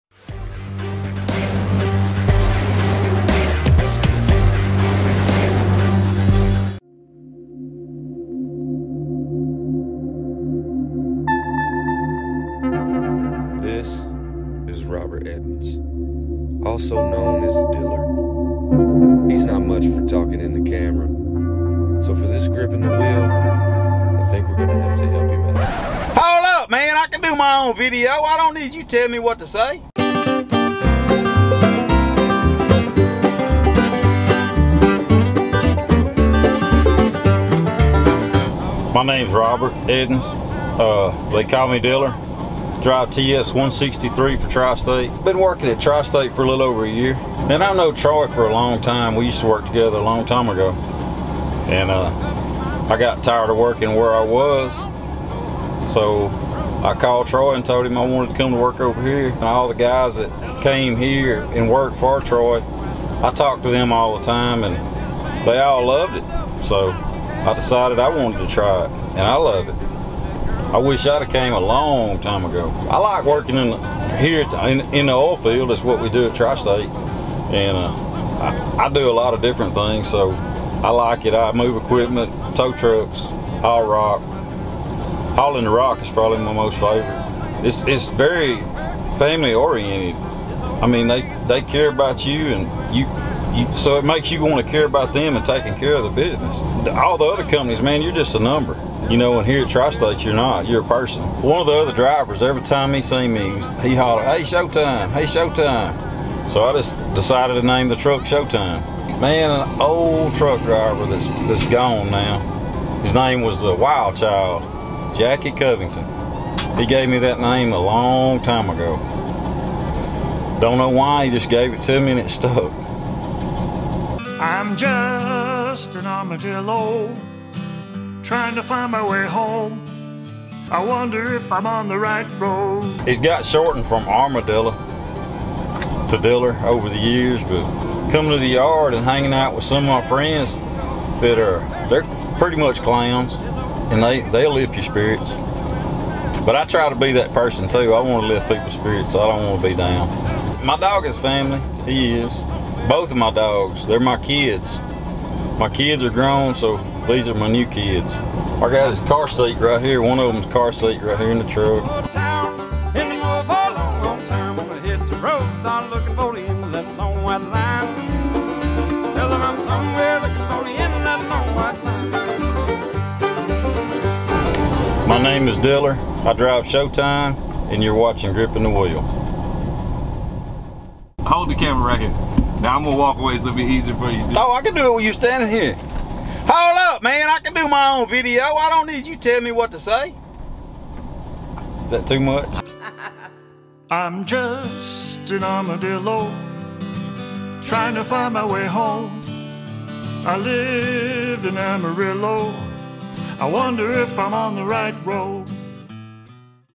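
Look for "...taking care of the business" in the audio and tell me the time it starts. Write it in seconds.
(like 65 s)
95 s.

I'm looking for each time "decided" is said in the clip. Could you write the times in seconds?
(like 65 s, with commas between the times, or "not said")
67 s, 107 s.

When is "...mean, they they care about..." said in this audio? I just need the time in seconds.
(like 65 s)
90 s.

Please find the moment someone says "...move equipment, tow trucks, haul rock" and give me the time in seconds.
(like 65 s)
81 s.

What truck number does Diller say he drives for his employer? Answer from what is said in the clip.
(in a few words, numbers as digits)
TS163.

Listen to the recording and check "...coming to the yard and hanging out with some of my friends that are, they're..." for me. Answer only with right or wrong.
right.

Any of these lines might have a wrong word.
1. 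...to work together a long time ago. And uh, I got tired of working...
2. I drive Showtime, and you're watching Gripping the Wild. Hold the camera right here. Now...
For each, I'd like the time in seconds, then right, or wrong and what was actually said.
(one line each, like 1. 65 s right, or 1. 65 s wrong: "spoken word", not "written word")
1. 49 s right
2. 176 s wrong: "Wheel", not "Wild".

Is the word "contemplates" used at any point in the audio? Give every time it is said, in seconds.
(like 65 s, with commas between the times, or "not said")
not said.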